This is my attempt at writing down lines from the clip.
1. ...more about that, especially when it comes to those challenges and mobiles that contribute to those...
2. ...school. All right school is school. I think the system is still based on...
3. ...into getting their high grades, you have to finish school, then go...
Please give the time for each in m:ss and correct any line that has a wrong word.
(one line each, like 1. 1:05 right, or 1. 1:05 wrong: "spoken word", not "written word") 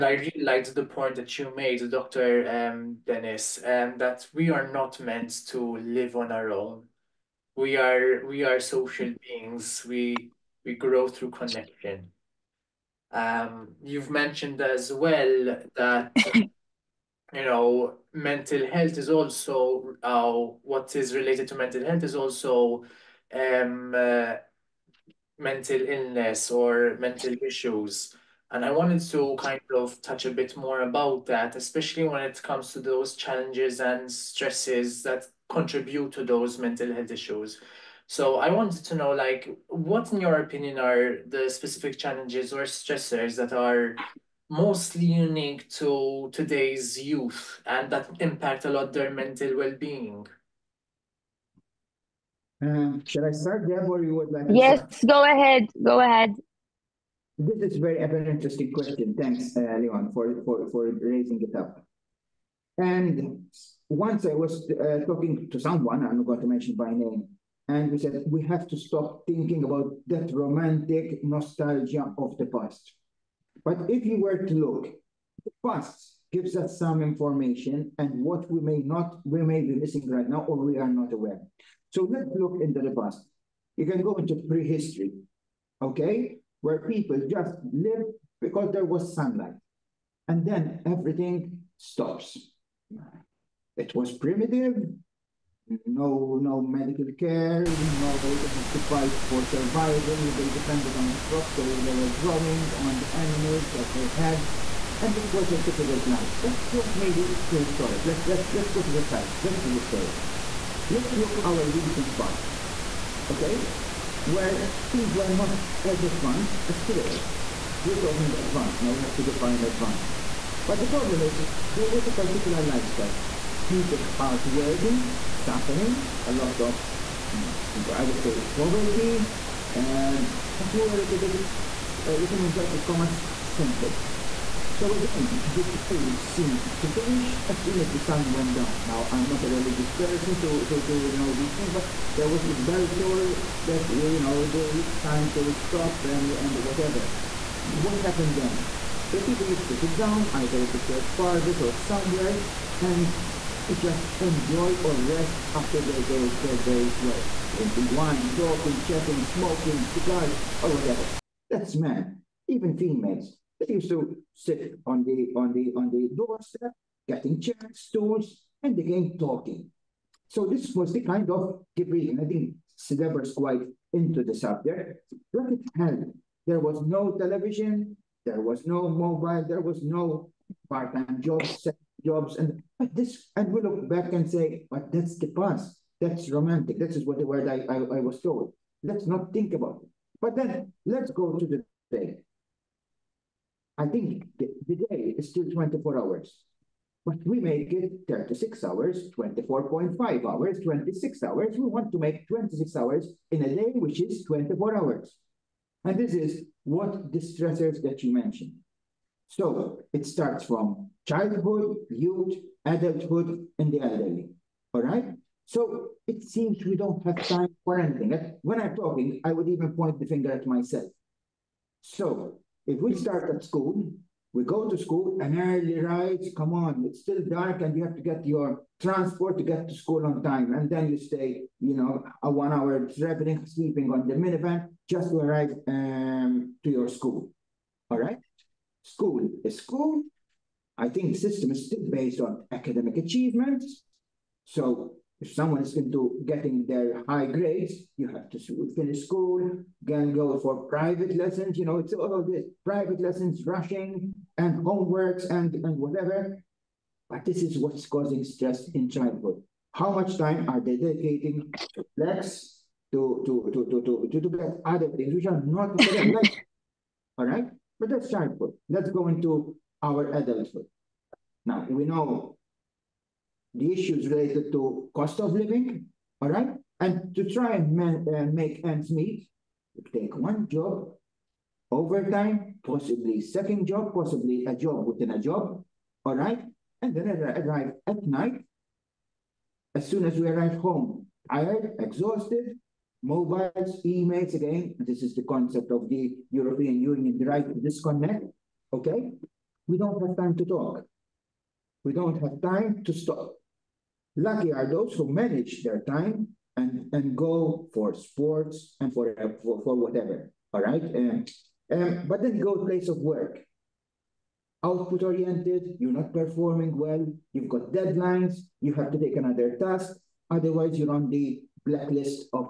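1. 0:30 wrong: "stresses", not "mobiles"
2. 3:56 right
3. 4:05 right.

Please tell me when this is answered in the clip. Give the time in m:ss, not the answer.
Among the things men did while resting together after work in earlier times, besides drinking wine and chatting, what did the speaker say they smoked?
2:39.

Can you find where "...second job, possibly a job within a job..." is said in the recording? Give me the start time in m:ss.
4:43.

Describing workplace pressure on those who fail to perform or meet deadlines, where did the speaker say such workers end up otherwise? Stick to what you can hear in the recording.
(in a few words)
on the blacklist.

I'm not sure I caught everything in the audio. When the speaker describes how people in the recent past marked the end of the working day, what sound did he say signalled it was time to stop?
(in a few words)
the bell toll.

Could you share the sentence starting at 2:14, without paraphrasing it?
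So again, the day seemed to finish as soon as the sun went down.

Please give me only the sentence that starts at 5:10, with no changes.
Um, um, but then go place of work.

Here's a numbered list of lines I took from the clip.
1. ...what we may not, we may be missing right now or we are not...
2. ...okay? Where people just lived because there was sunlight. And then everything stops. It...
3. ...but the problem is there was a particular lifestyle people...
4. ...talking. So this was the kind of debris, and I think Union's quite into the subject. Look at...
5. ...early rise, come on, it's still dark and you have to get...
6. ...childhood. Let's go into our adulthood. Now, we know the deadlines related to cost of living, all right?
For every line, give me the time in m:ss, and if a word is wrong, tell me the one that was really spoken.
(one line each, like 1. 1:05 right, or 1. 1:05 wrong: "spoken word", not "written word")
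1. 1:18 right
2. 1:25 right
3. 2:00 right
4. 2:49 wrong: "Sideber", not "Union"
5. 3:45 right
6. 4:28 wrong: "issues", not "deadlines".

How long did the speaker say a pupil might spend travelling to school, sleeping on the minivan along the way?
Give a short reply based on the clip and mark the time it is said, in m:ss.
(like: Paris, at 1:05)
one hour, at 3:52.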